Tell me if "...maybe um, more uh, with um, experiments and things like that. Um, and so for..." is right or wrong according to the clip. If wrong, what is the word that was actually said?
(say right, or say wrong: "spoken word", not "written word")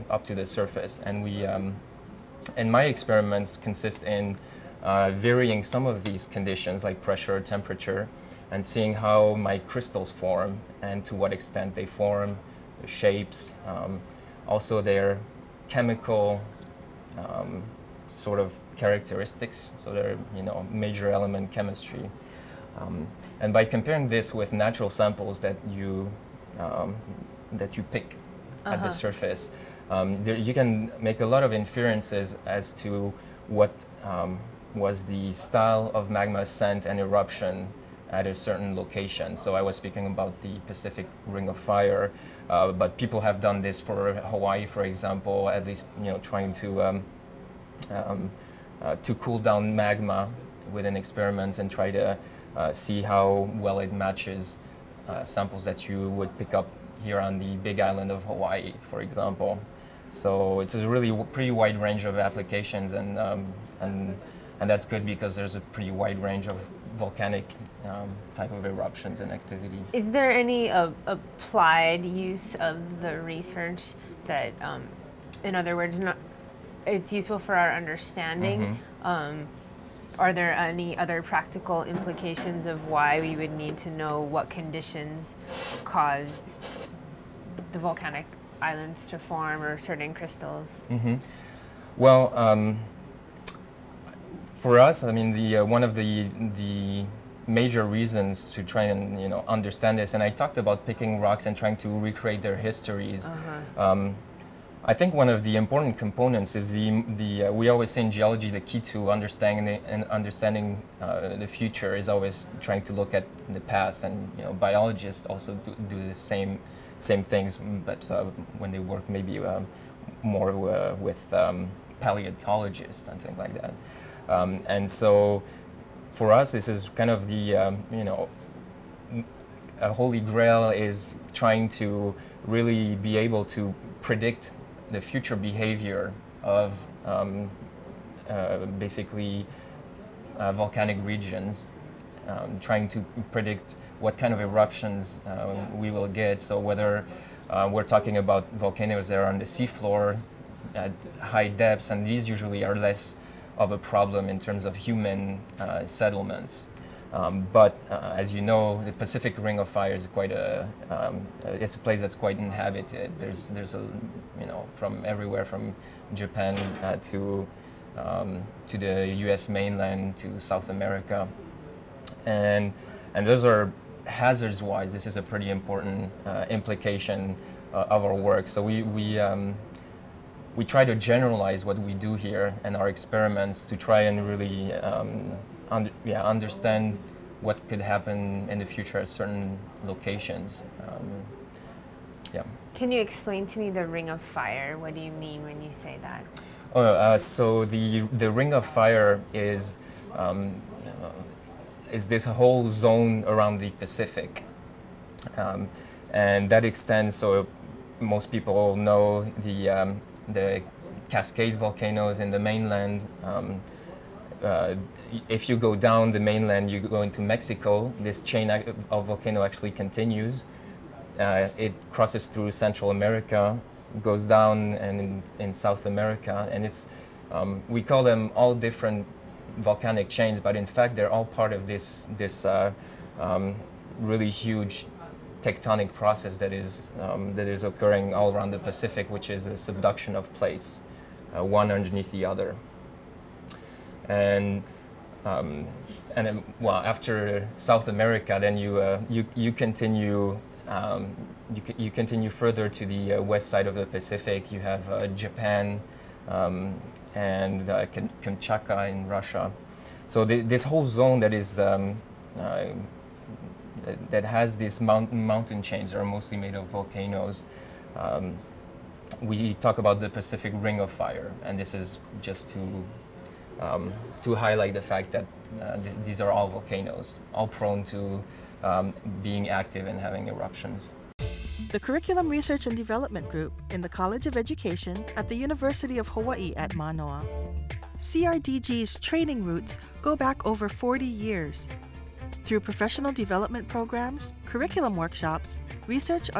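wrong: "paleontologists", not "experiments".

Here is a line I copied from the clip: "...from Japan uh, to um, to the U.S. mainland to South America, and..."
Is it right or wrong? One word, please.
right.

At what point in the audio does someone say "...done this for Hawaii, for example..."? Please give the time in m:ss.
0:43.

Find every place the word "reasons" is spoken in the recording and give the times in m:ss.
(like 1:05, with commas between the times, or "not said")
1:37.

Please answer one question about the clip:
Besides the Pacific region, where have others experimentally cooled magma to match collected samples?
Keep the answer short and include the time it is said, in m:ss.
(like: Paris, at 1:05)
Big Island of Hawaii, at 0:57.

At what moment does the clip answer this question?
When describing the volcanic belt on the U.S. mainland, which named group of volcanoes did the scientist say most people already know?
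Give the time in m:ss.
3:31.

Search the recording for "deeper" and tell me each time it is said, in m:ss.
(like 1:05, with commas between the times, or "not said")
not said.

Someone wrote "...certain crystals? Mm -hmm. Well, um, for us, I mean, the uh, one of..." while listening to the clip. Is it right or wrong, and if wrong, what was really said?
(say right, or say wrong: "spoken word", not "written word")
right.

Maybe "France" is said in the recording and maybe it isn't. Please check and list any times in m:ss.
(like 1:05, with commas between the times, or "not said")
not said.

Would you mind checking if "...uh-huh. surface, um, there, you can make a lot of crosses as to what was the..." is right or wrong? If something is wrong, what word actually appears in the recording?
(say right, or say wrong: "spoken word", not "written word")
wrong: "inferences", not "crosses".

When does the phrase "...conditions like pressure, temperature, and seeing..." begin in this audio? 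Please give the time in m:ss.
0:06.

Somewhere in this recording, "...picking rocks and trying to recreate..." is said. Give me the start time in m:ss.
1:40.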